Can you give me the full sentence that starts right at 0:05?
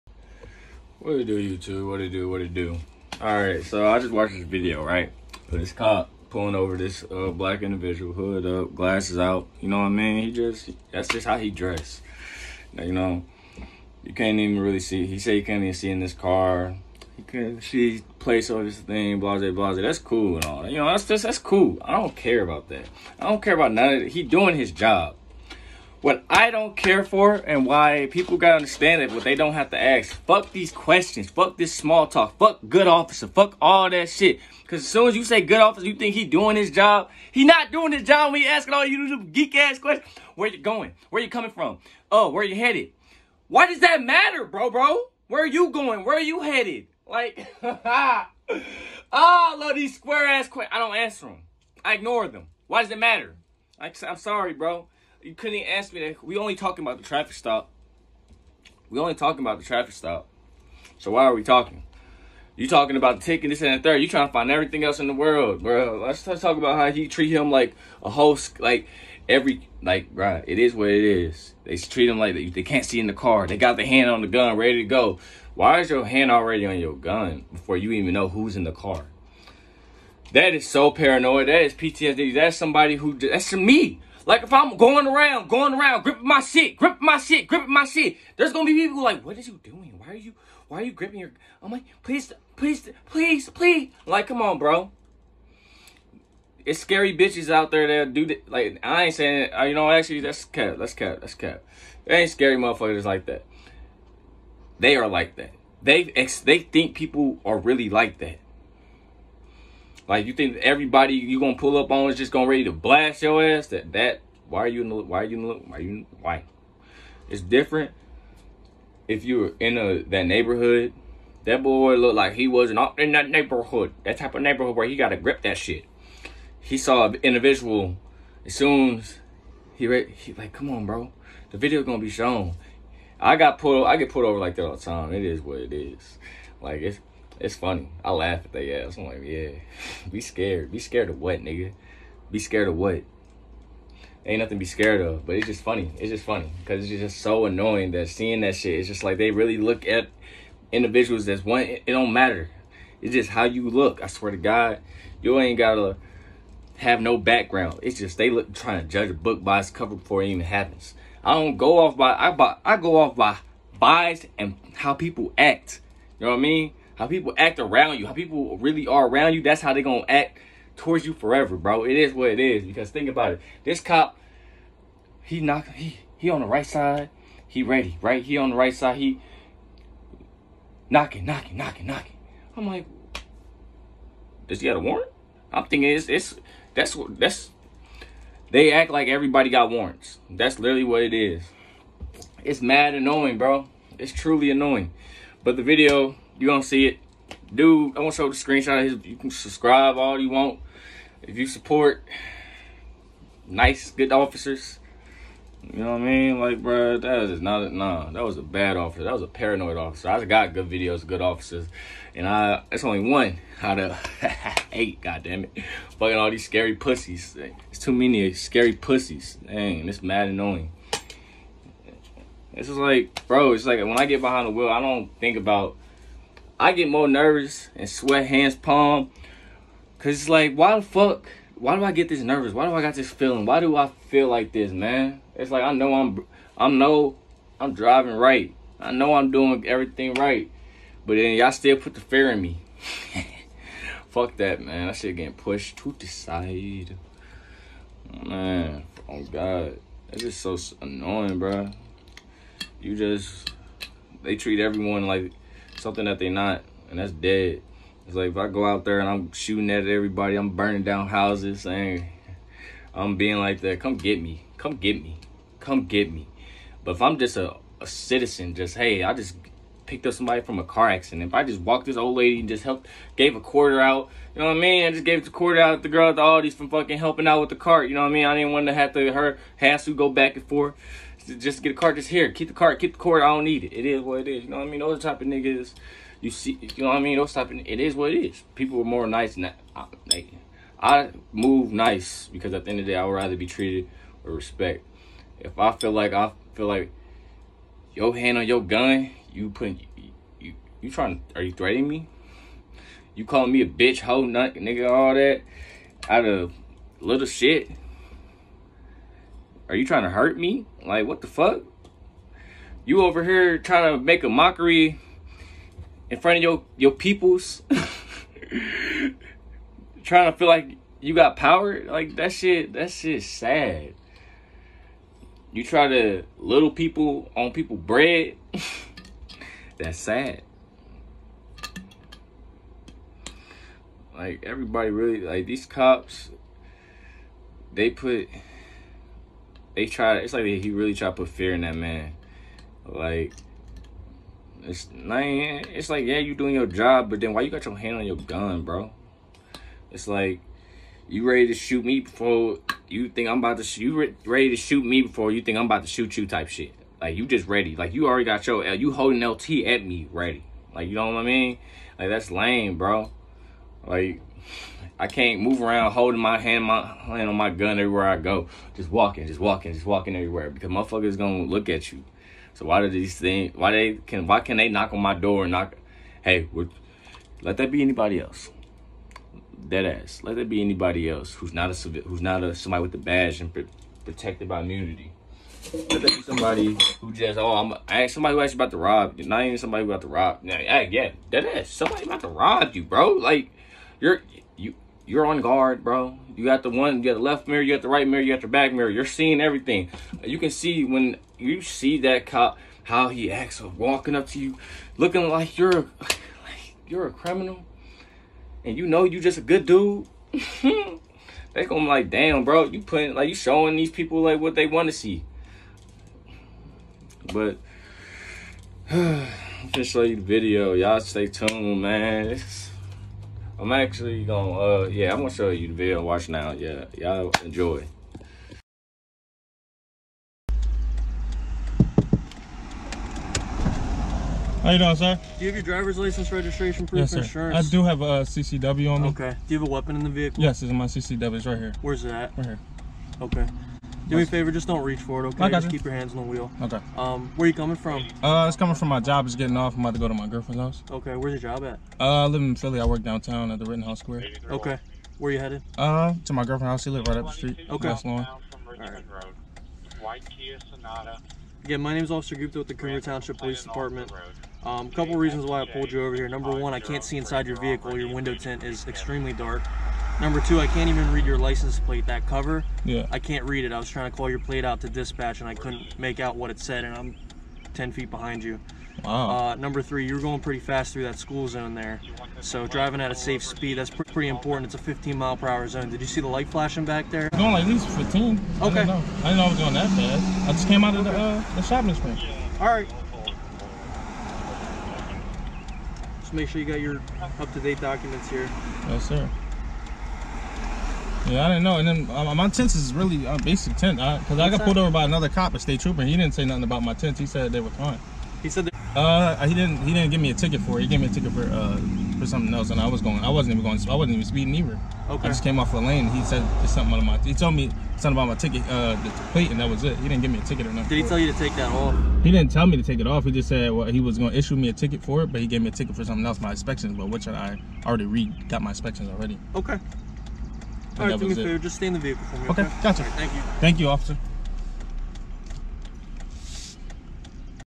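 This cop pulling over this uh, black individual, hood up, glasses out.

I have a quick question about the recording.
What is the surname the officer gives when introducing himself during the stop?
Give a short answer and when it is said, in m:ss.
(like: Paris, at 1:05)
Gupta, at 7:42.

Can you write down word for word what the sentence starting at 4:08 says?
Man, oh god, that's just so annoying, bro.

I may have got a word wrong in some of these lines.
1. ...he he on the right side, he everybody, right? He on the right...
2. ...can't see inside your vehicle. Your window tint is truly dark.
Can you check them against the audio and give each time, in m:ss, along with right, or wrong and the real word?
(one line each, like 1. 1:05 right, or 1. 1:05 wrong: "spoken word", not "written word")
1. 2:55 wrong: "ready", not "everybody"
2. 7:46 wrong: "extremely", not "truly".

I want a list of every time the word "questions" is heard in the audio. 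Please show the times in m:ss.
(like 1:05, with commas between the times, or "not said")
0:30, 0:39, 0:50.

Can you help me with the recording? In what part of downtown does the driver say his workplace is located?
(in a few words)
Rittenhouse Square.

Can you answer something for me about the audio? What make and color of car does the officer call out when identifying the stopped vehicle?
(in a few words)
White Kia Sonata.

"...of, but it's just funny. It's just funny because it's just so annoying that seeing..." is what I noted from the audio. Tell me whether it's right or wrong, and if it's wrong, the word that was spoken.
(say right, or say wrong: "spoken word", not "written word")
right.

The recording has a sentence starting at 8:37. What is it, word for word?
He told me something about my ticket, uh, the plate, and that was it.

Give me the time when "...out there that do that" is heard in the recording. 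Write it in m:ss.
1:37.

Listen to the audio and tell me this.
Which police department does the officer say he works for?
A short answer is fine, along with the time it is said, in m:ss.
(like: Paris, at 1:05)
Coomer Township Police Department, at 7:42.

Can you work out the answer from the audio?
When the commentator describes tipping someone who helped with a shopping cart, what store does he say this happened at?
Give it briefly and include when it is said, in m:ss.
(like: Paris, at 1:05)
Aldi's, at 4:36.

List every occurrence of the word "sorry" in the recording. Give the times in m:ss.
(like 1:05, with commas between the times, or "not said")
0:54.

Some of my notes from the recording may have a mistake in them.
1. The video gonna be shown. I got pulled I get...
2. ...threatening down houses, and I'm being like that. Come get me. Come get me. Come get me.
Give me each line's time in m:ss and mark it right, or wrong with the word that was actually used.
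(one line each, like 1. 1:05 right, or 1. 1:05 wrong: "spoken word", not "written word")
1. 2:11 right
2. 4:20 wrong: "burning", not "threatening".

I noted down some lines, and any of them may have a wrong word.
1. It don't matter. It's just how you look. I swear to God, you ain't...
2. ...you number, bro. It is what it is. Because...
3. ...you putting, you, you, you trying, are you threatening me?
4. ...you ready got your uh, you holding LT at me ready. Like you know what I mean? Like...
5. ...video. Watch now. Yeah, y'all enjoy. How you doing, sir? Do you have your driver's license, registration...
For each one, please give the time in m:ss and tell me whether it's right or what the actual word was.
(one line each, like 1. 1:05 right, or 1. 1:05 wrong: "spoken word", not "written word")
1. 2:31 right
2. 2:51 wrong: "forever", not "number"
3. 4:59 right
4. 5:57 wrong: "already", not "ready"
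5. 7:05 right.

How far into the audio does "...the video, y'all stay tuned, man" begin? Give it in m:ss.
7:00.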